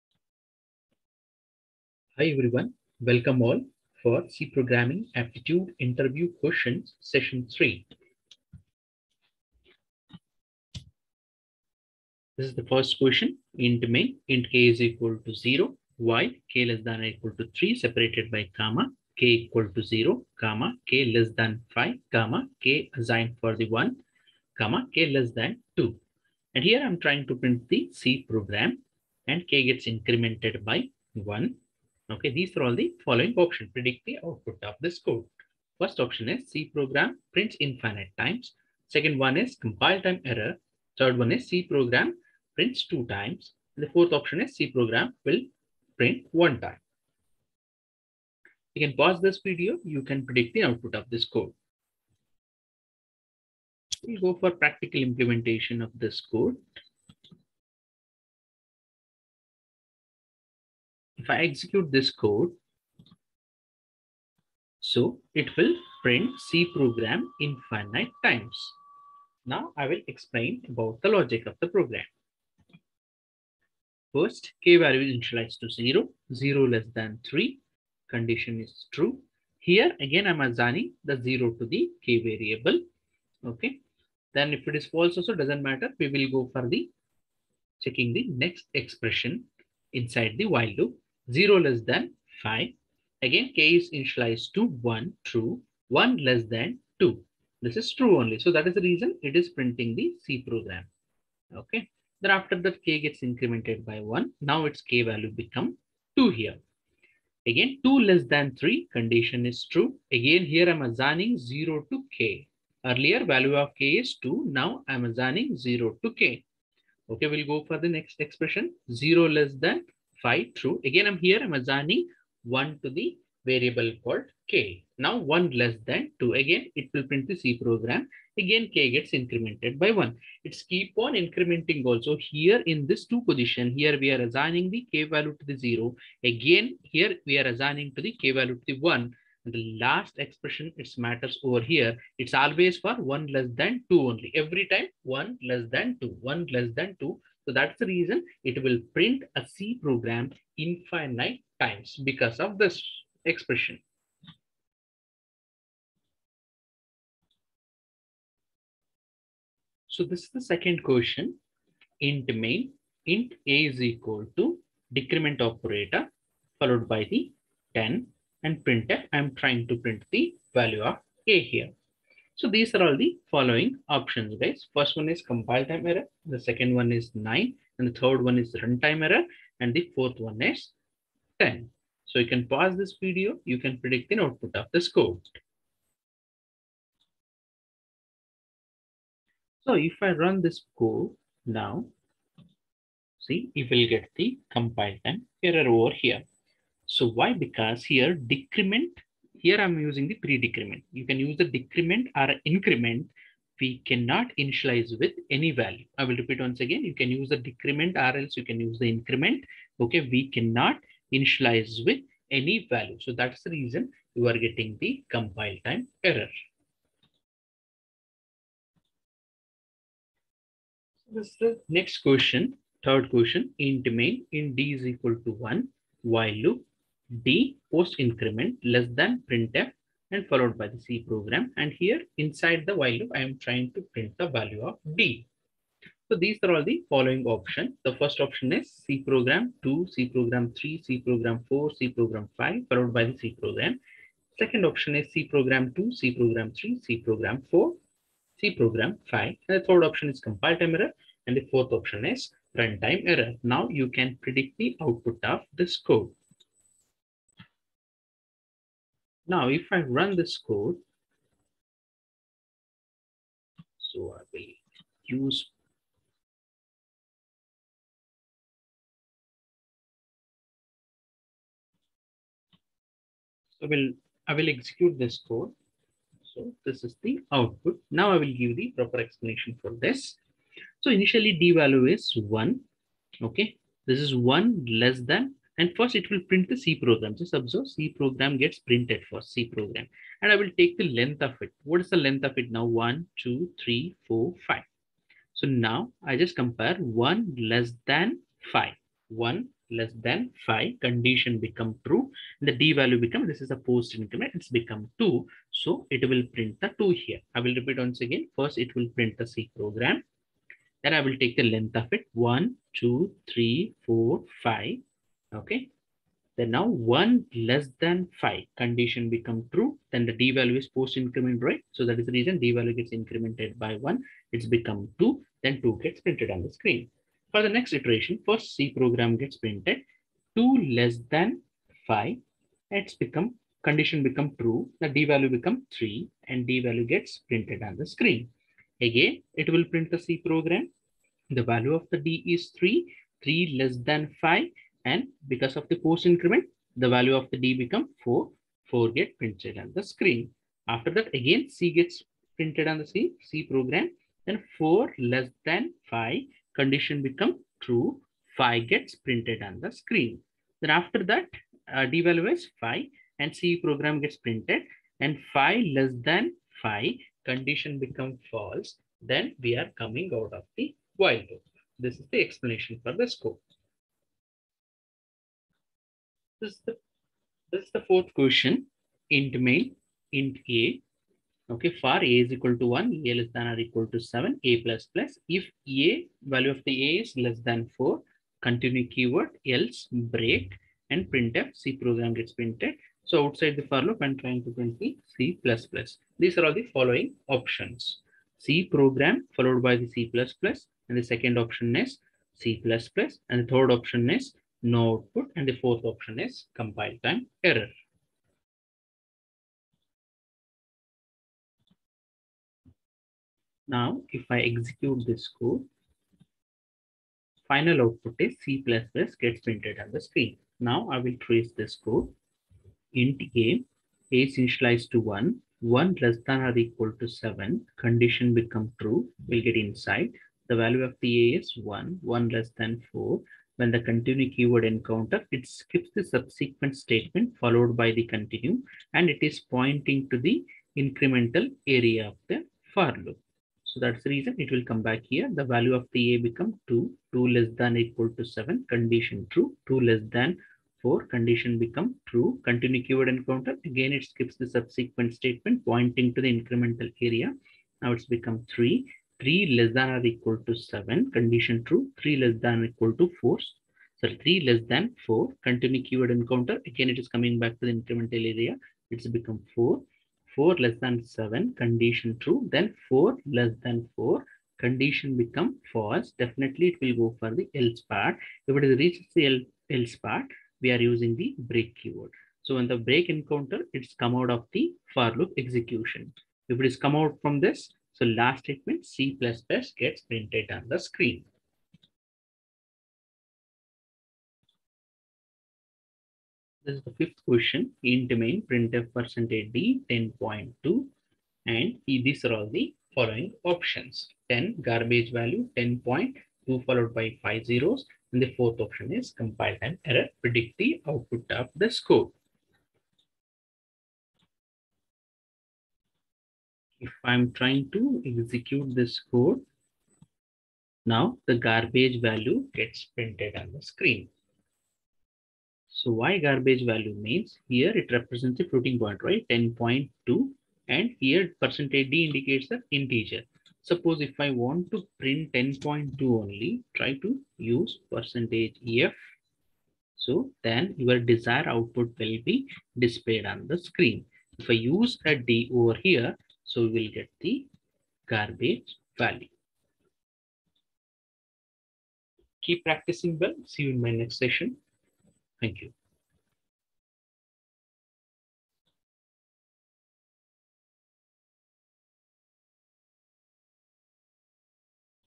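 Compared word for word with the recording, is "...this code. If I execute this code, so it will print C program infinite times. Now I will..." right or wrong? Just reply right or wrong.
right.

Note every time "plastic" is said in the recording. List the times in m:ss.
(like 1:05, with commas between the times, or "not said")
not said.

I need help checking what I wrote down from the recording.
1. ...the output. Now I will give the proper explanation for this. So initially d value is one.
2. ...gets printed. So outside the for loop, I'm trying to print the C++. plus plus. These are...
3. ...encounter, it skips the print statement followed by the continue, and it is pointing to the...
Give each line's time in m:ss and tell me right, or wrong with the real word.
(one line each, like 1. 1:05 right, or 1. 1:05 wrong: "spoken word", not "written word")
1. 4:37 right
2. 6:32 right
3. 7:14 wrong: "subsequent", not "print".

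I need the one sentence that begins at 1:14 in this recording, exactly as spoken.
First, k value is initialized to 0, 0 less than 3, condition is true.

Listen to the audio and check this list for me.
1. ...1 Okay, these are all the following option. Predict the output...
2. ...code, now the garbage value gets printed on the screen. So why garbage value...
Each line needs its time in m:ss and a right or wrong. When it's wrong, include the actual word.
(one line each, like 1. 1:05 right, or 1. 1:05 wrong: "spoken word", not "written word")
1. 0:31 right
2. 8:39 right.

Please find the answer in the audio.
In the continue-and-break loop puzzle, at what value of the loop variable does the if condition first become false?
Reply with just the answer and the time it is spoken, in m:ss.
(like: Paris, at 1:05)
4, at 7:52.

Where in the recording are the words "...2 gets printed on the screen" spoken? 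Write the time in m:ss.
5:25.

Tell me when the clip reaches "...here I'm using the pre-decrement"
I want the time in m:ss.
3:19.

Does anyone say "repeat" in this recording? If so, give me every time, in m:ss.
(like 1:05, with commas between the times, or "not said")
3:26, 5:07.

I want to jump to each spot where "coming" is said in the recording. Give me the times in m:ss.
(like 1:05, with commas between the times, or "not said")
6:09, 7:47.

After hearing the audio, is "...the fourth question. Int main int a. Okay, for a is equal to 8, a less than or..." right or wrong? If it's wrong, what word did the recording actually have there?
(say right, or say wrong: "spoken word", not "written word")
wrong: "1", not "8".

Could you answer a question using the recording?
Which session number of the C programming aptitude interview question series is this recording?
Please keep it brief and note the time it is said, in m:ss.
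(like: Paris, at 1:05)
3, at 0:06.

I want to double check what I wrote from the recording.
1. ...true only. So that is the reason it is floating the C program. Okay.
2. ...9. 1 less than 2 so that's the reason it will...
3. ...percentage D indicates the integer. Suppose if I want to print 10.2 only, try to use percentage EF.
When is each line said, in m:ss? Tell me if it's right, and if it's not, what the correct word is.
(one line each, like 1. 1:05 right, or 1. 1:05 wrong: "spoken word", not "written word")
1. 1:37 wrong: "printing", not "floating"
2. 2:25 wrong: "2", not "9"
3. 8:51 right.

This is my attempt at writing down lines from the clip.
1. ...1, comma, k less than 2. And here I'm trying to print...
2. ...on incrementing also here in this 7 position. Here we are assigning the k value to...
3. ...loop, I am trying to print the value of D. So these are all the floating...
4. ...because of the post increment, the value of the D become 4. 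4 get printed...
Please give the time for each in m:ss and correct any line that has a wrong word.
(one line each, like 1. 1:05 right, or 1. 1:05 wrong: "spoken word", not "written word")
1. 0:23 right
2. 2:10 wrong: "2", not "7"
3. 3:52 wrong: "following", not "floating"
4. 5:45 right.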